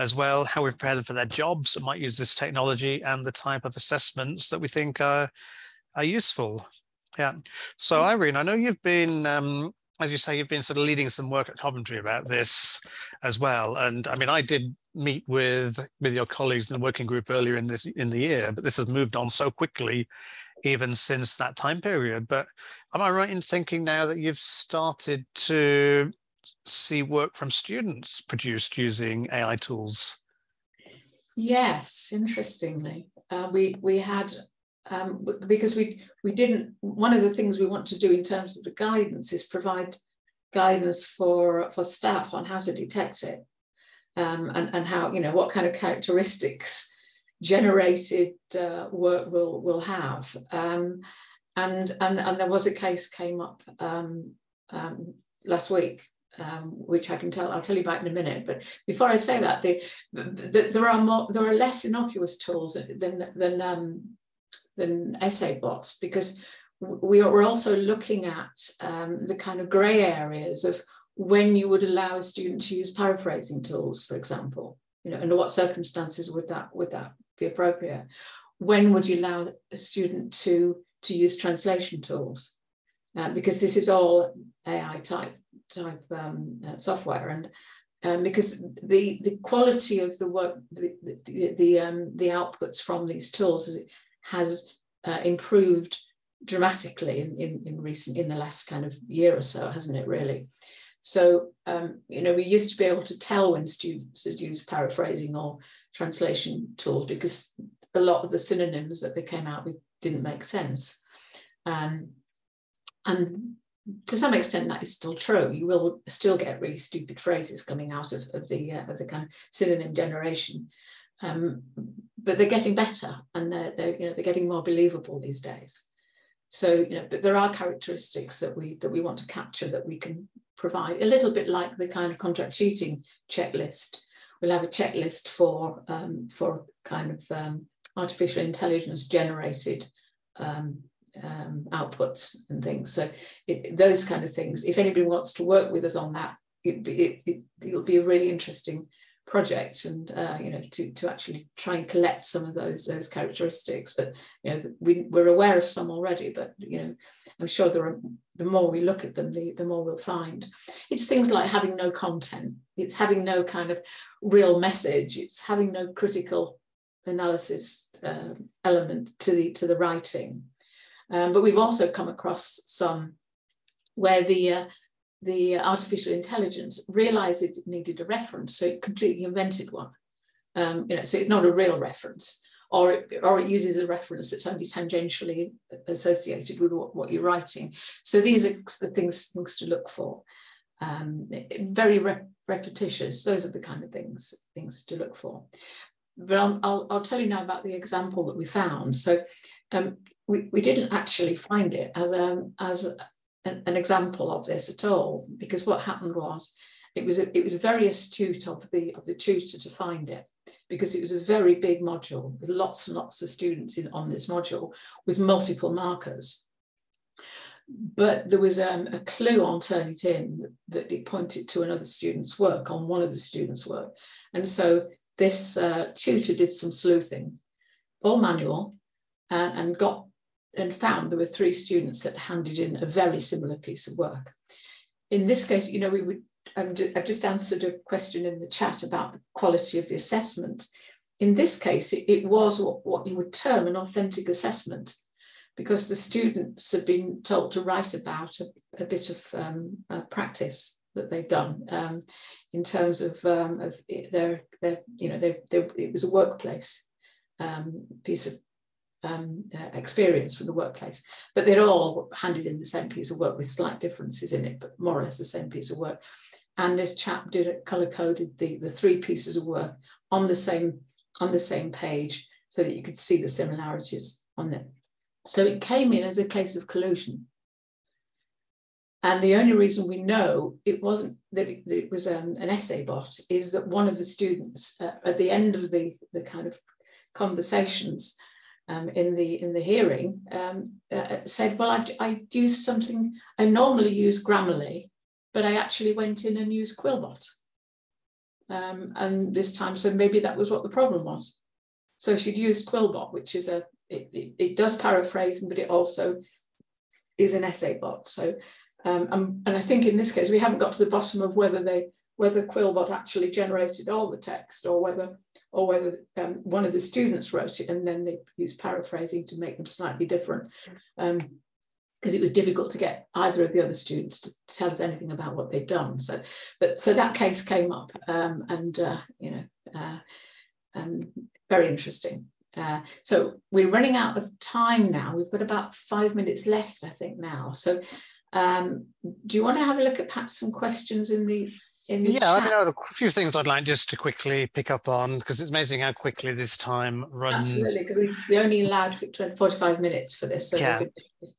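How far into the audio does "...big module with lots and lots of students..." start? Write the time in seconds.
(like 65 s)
211 s.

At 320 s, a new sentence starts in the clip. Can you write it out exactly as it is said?
Um, because it was difficult to get either of the other students to tell us anything about what they'd done.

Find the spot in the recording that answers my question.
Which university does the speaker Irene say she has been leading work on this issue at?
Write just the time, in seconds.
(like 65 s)
11 s.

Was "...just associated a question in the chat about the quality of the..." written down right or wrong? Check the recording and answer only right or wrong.
wrong.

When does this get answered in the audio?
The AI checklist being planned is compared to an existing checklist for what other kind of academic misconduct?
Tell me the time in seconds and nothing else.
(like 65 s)
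132 s.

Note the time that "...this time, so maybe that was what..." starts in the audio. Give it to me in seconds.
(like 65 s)
299 s.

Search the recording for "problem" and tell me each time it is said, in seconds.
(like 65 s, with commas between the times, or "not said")
300 s.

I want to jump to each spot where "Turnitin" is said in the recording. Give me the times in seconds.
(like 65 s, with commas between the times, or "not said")
219 s.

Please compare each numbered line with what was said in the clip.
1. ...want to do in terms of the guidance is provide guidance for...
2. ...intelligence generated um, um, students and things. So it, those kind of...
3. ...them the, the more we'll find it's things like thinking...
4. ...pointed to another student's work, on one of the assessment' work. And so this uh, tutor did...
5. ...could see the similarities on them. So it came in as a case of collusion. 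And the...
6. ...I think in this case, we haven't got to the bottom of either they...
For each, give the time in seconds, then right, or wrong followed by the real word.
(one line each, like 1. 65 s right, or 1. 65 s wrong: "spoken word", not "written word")
1. 37 s right
2. 138 s wrong: "outputs", not "students"
3. 159 s wrong: "having", not "thinking"
4. 221 s wrong: "students", not "assessment"
5. 272 s right
6. 309 s wrong: "whether", not "either".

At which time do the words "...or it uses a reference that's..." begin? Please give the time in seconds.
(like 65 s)
183 s.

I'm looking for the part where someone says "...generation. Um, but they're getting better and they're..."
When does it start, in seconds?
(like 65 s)
119 s.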